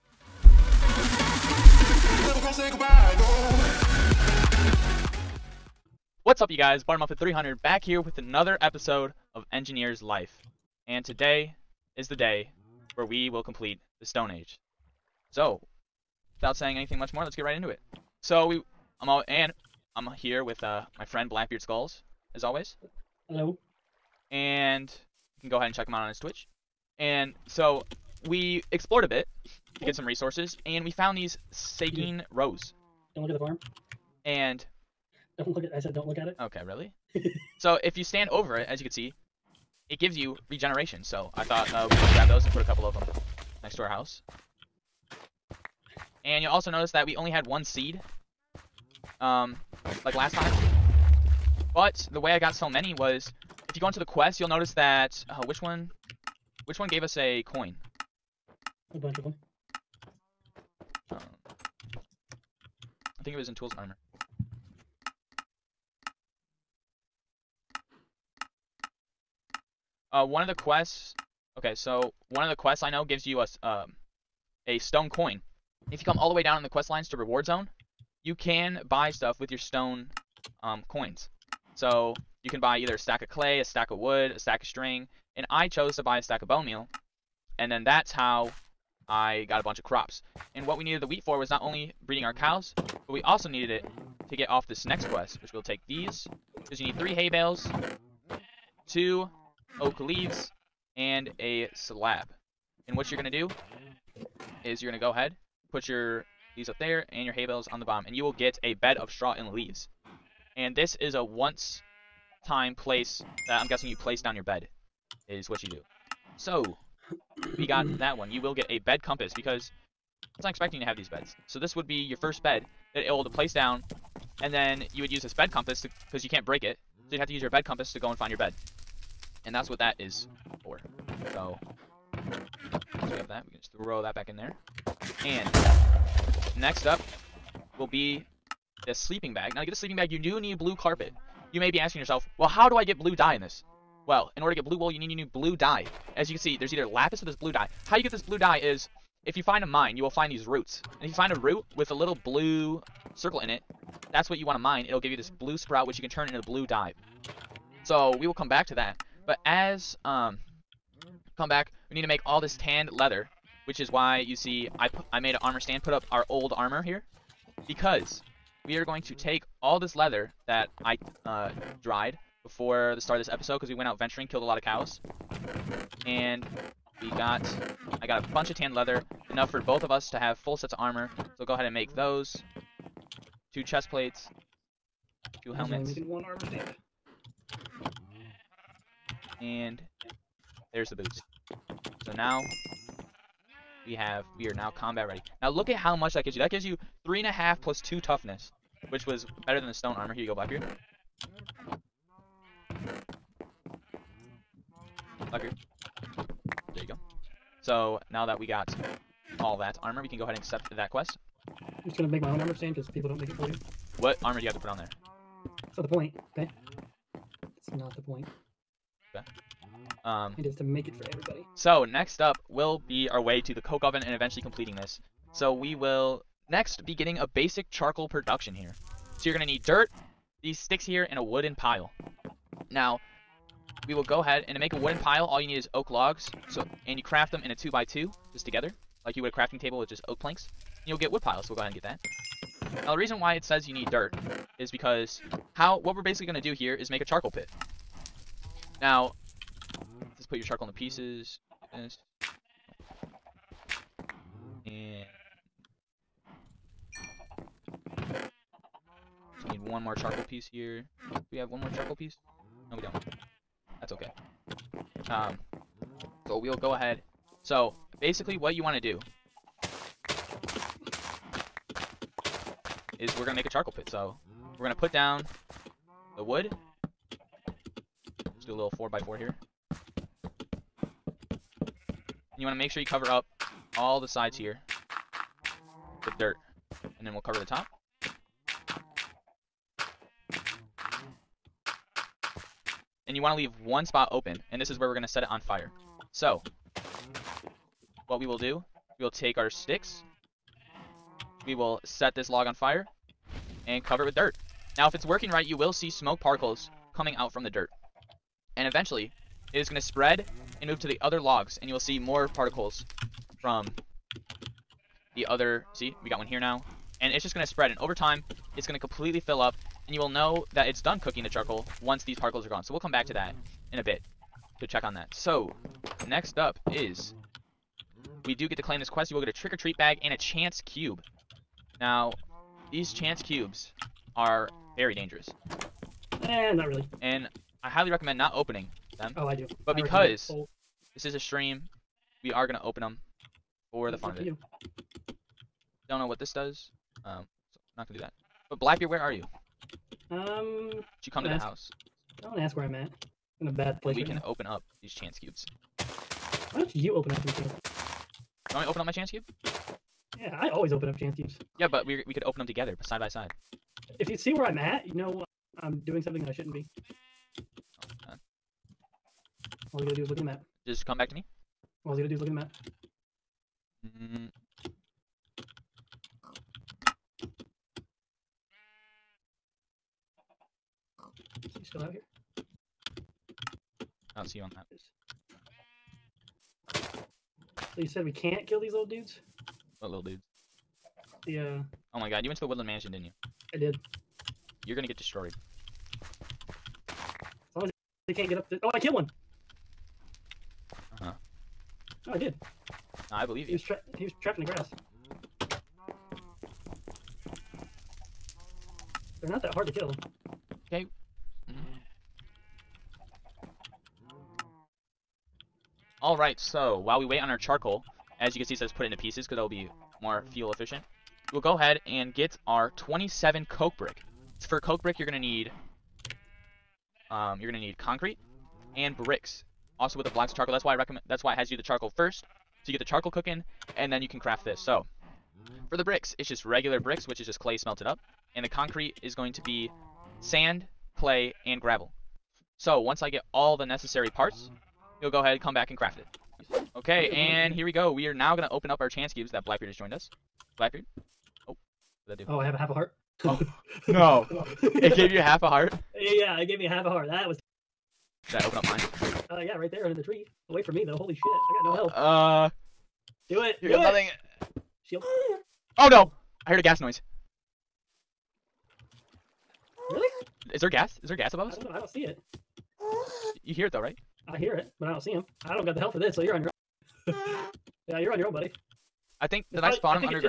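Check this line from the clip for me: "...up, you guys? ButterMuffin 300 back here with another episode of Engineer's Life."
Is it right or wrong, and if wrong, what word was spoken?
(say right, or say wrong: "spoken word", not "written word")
right.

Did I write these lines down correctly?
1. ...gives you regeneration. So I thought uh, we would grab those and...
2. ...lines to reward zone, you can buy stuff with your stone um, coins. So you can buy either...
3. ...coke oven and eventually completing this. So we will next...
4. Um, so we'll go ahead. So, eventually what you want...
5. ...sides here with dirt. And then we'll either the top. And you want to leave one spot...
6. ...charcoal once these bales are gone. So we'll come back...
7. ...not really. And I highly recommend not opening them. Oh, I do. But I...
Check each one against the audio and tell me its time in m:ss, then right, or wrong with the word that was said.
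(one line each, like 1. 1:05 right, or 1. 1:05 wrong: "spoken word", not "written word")
1. 0:39 right
2. 1:16 right
3. 3:43 right
4. 4:25 wrong: "basically", not "eventually"
5. 4:44 wrong: "cover", not "either"
6. 5:21 wrong: "particles", not "bales"
7. 5:36 right.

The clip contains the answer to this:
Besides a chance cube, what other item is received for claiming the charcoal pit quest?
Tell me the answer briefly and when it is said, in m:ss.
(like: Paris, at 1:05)
trick-or-treat bag, at 5:29.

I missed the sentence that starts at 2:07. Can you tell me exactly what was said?
So you'd have to use your bed compass to go and find your bed.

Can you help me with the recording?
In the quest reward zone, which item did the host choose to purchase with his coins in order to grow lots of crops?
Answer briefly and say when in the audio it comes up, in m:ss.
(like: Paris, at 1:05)
bone meal, at 1:26.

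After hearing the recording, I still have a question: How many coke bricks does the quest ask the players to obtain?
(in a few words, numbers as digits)
27.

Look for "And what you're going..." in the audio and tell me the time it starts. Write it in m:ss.
1:42.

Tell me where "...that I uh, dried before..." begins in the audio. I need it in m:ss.
2:50.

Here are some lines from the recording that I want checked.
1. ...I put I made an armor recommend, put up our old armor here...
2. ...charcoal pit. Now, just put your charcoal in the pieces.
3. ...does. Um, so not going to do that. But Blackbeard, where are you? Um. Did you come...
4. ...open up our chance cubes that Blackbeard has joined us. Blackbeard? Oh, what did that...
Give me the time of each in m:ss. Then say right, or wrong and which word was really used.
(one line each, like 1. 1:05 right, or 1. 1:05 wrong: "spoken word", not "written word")
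1. 2:44 wrong: "stand", not "recommend"
2. 4:07 right
3. 5:46 right
4. 7:28 right.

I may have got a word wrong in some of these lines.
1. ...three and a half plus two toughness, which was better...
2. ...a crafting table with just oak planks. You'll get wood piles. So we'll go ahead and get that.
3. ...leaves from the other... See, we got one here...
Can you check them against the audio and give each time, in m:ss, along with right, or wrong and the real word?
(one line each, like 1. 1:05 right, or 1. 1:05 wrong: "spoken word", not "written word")
1. 3:17 right
2. 3:59 right
3. 5:12 wrong: "particles", not "leaves".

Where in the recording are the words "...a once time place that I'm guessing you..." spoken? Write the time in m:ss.
1:51.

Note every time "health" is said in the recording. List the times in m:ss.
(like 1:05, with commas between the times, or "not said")
7:41, 7:55.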